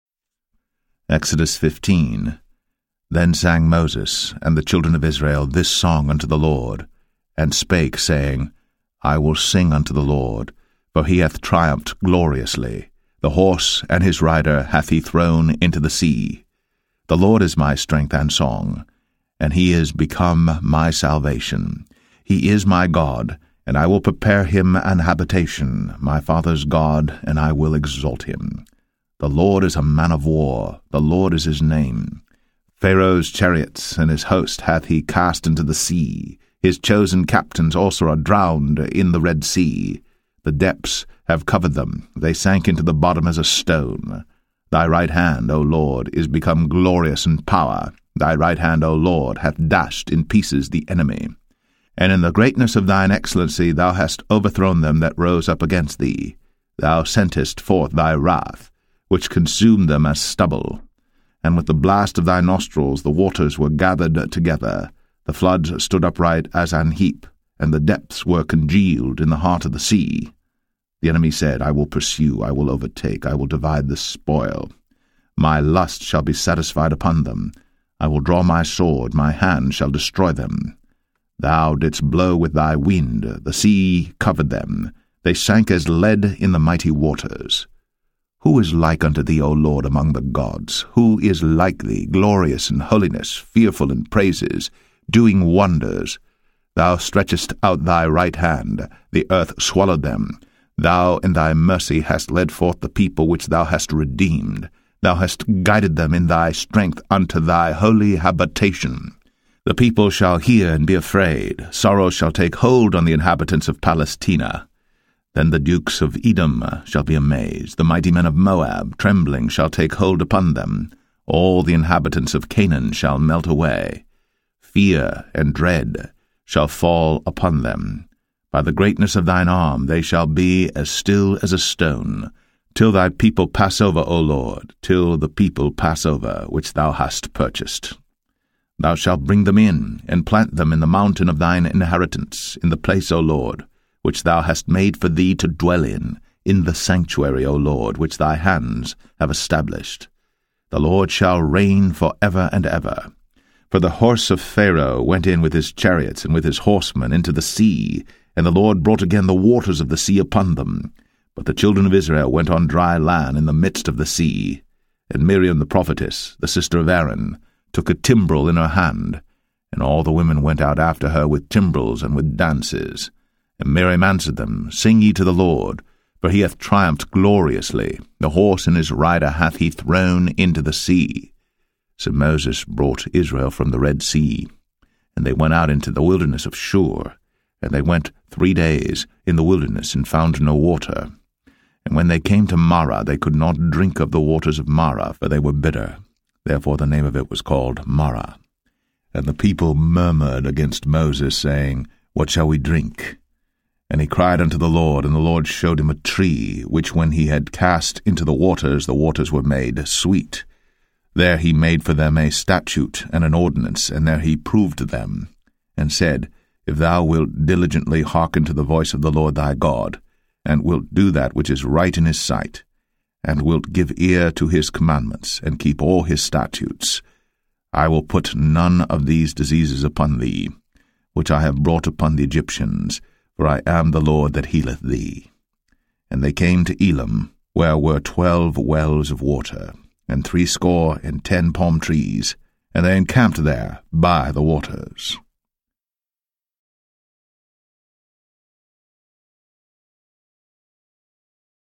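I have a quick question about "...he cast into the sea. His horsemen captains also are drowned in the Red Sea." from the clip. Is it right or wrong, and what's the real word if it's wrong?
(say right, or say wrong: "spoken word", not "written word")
wrong: "chosen", not "horsemen".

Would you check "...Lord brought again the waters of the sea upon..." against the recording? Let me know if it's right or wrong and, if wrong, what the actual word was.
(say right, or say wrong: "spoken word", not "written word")
right.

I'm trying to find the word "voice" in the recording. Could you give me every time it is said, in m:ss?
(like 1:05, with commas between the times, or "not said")
3:38.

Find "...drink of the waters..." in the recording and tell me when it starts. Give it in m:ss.
3:13.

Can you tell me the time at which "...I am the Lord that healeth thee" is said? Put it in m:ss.
3:53.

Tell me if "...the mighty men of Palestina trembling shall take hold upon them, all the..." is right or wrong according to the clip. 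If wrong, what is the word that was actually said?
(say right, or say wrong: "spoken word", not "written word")
wrong: "Moab", not "Palestina".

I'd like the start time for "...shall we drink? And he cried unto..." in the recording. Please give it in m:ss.
3:22.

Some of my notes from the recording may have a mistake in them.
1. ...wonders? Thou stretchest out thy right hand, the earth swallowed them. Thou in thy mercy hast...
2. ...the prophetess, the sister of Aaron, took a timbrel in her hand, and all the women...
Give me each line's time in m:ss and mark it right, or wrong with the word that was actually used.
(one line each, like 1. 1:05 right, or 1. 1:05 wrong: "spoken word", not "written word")
1. 1:35 right
2. 2:45 right.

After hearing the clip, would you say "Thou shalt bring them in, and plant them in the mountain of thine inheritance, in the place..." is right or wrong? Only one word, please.
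right.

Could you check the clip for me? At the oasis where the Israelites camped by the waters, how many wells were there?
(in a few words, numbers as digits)
12.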